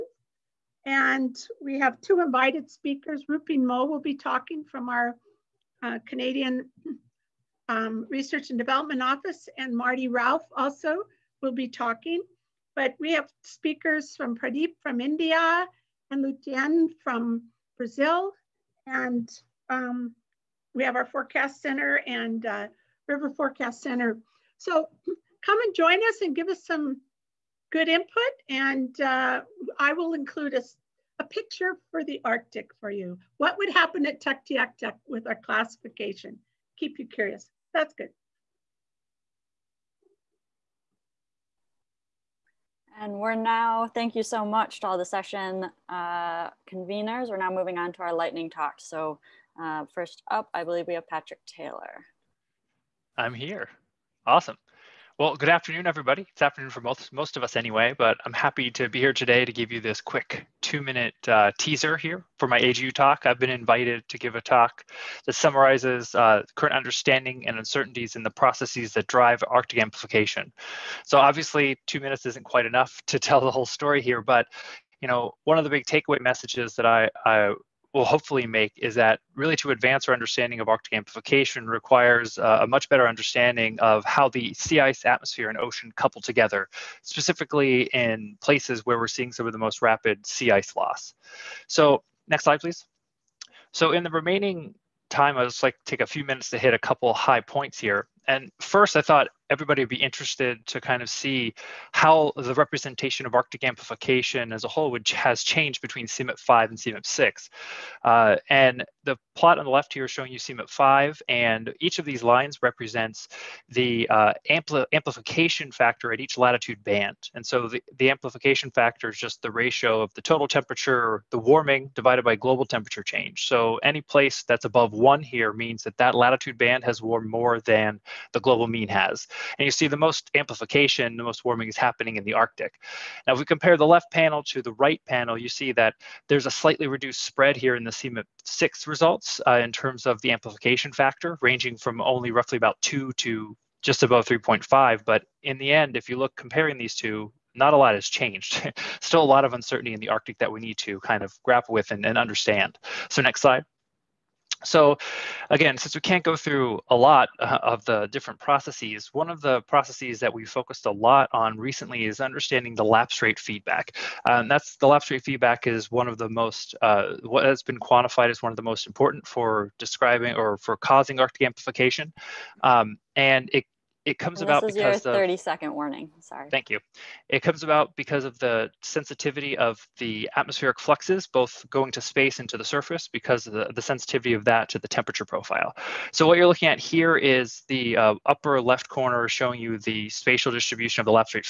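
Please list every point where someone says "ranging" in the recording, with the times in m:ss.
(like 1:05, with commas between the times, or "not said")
2:21.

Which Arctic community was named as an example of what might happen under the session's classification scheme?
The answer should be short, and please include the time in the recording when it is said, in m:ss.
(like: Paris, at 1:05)
Tuktoyaktuk, at 0:34.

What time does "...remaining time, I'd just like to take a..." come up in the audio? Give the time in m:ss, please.
1:34.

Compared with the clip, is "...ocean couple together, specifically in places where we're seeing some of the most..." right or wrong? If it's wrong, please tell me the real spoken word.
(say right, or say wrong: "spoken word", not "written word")
right.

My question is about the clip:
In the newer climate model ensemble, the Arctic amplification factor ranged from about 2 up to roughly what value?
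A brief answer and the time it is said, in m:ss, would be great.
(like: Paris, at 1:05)
just above 3.5, at 2:23.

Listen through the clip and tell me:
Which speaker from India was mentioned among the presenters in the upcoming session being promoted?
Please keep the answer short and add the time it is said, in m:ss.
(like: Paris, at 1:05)
Pradeep, at 0:14.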